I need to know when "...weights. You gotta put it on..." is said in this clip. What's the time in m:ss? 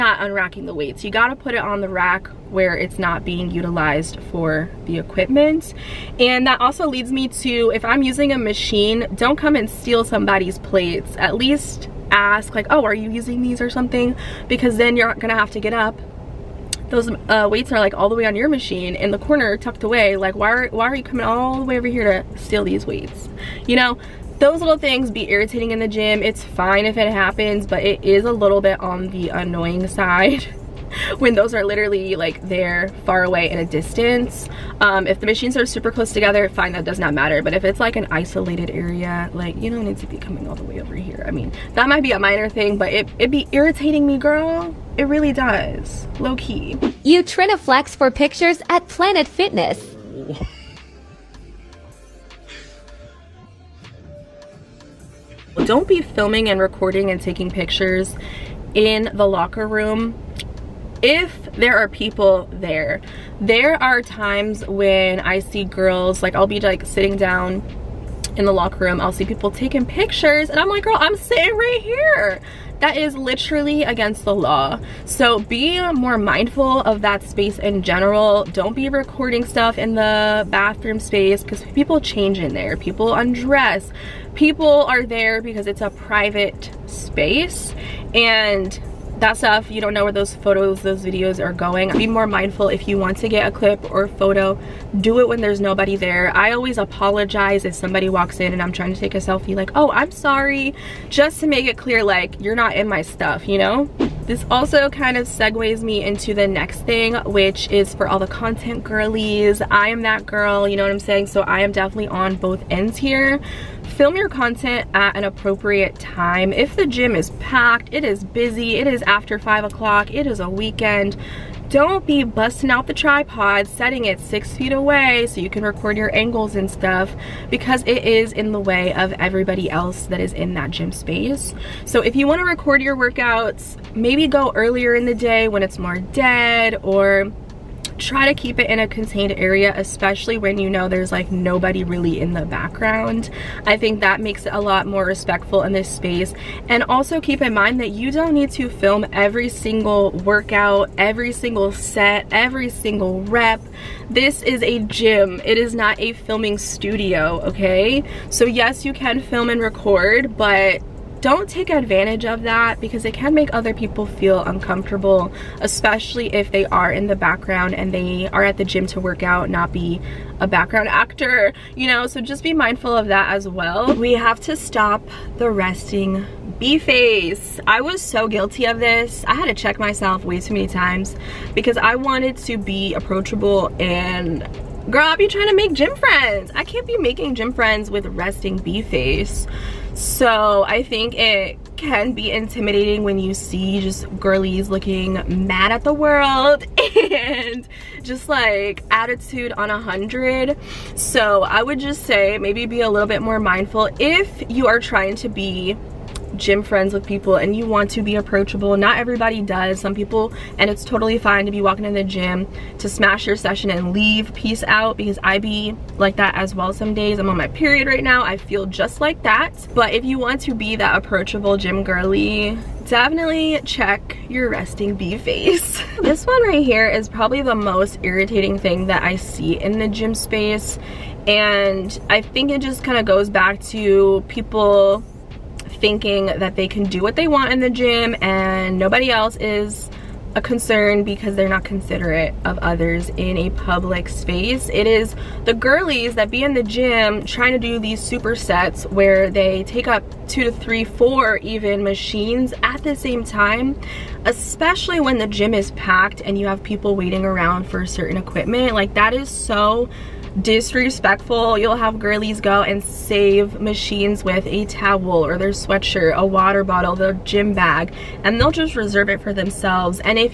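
0:00.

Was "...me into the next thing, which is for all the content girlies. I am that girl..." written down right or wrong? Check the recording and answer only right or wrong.
right.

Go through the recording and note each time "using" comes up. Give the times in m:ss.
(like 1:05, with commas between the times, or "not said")
0:08, 0:13.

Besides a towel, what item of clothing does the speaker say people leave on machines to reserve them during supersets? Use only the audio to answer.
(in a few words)
sweatshirt.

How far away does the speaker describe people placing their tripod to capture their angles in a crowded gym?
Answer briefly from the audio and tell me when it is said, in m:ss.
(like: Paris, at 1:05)
6 feet, at 2:04.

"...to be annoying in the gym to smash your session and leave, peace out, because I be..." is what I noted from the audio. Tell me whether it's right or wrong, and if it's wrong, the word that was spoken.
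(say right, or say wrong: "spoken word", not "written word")
wrong: "walking", not "annoying".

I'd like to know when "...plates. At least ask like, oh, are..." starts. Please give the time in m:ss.
0:10.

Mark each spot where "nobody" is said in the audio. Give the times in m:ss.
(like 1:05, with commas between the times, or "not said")
1:35, 2:21, 3:58.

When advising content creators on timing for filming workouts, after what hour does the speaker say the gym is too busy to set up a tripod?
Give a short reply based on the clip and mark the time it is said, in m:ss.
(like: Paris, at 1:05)
5 o'clock, at 1:59.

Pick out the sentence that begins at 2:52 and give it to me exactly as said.
So just be mindful of that as well.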